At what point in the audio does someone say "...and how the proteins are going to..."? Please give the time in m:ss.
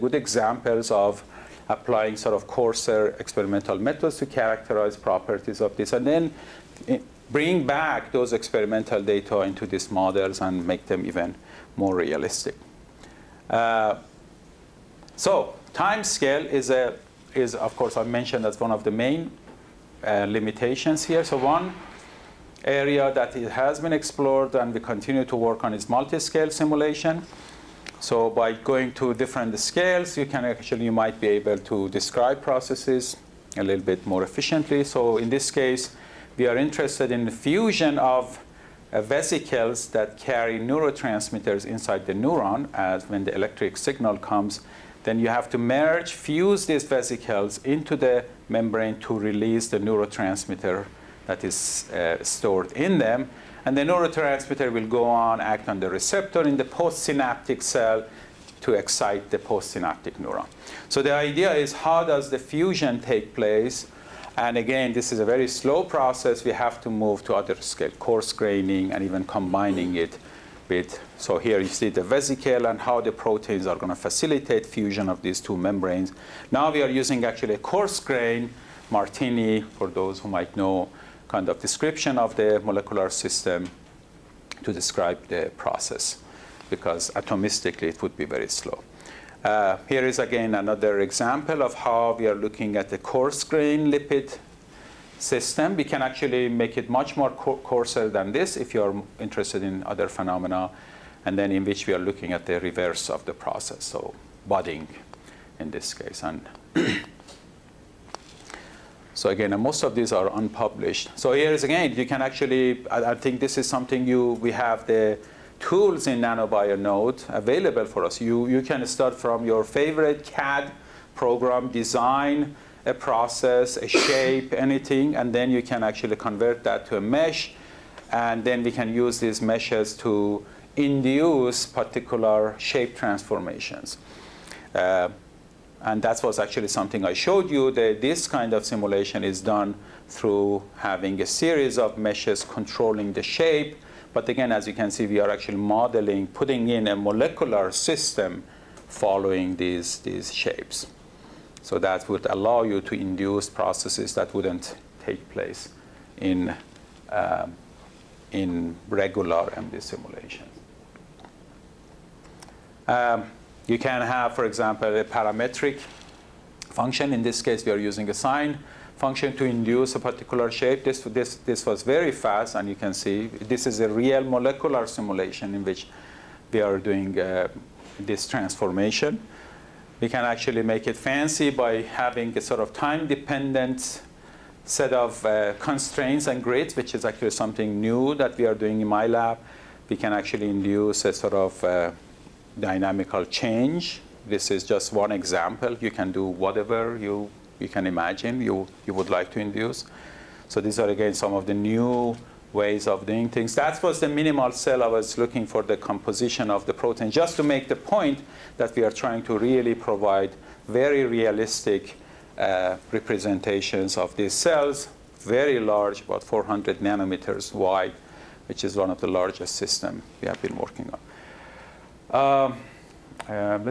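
1:12.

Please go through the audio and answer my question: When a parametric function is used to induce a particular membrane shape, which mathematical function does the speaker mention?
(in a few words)
Sine function.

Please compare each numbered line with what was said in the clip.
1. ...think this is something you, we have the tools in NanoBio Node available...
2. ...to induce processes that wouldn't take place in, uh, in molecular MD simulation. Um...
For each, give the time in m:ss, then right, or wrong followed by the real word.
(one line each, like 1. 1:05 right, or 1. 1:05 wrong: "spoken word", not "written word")
1. 1:53 right
2. 2:32 wrong: "regular", not "molecular".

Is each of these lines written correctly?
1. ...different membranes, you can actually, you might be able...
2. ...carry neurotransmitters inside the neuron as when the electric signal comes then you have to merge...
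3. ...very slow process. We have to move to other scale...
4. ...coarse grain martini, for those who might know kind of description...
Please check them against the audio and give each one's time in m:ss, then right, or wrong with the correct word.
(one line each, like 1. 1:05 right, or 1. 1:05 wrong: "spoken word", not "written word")
1. 0:29 wrong: "scales", not "membranes"
2. 0:40 right
3. 1:05 right
4. 1:17 right.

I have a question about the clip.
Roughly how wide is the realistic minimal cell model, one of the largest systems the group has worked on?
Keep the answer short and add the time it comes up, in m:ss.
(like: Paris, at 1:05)
400 nanometers, at 3:36.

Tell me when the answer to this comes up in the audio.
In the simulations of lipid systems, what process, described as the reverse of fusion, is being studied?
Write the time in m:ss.
1:44.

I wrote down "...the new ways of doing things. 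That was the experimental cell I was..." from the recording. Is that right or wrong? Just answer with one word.
wrong.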